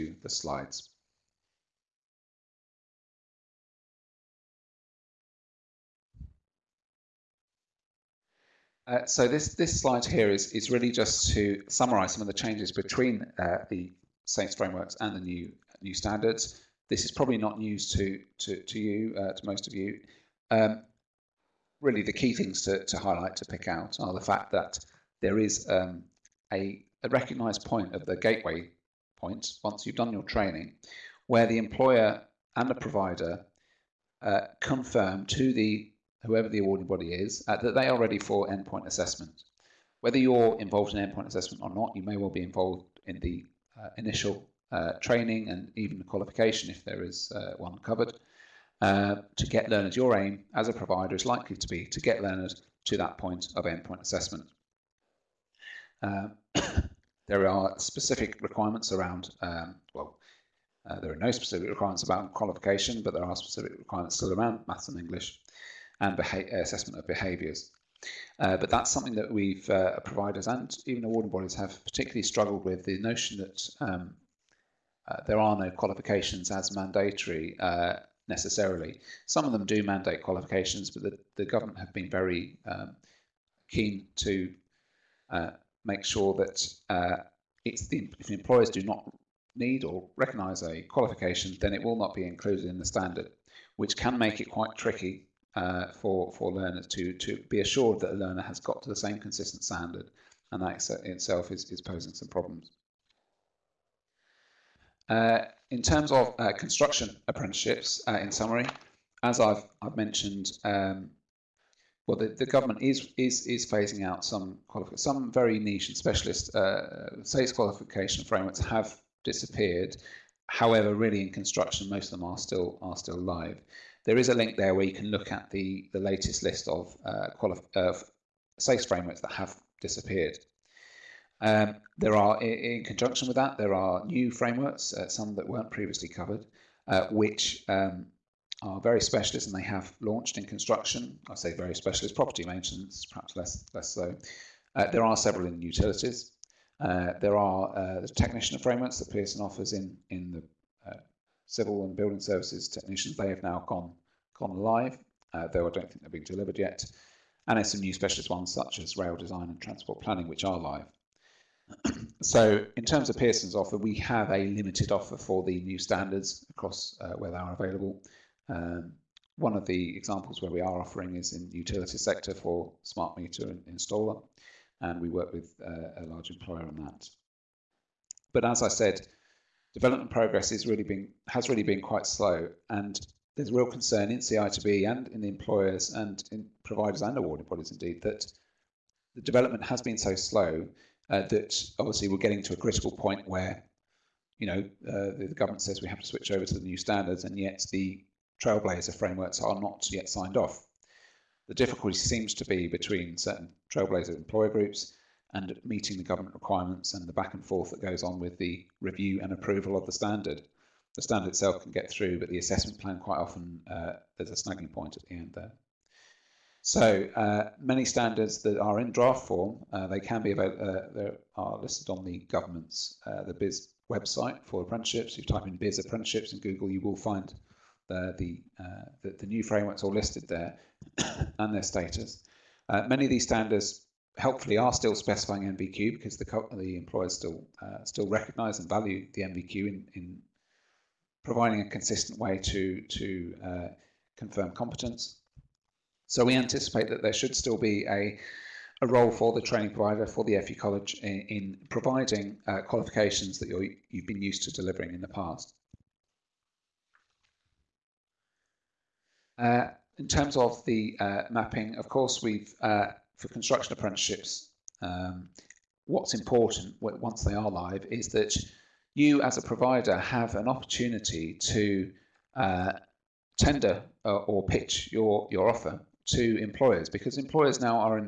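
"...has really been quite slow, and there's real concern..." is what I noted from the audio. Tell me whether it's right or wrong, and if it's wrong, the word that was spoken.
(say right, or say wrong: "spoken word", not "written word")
right.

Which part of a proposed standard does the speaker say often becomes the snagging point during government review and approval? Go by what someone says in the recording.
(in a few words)
the assessment plan.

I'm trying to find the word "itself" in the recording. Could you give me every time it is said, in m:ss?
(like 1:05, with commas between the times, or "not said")
1:41, 3:31.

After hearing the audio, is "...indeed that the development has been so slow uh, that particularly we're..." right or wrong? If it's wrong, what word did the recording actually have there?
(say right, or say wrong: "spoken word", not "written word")
wrong: "obviously", not "particularly".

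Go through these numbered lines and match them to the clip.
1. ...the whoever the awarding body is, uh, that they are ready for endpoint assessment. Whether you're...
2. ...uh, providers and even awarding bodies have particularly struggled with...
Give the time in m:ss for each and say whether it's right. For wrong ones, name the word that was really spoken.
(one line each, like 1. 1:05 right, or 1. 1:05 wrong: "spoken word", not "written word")
1. 0:35 right
2. 1:09 right.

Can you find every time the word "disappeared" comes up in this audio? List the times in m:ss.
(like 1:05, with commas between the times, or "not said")
1:59, 2:09.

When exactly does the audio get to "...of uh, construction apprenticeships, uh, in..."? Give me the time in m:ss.
1:46.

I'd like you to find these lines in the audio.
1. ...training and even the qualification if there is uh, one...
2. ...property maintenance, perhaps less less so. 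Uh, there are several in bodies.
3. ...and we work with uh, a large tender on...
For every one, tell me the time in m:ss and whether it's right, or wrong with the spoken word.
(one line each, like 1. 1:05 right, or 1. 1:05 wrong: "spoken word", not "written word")
1. 0:45 right
2. 2:22 wrong: "utilities", not "bodies"
3. 2:54 wrong: "employer", not "tender".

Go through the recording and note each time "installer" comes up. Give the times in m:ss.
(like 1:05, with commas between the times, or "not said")
2:53.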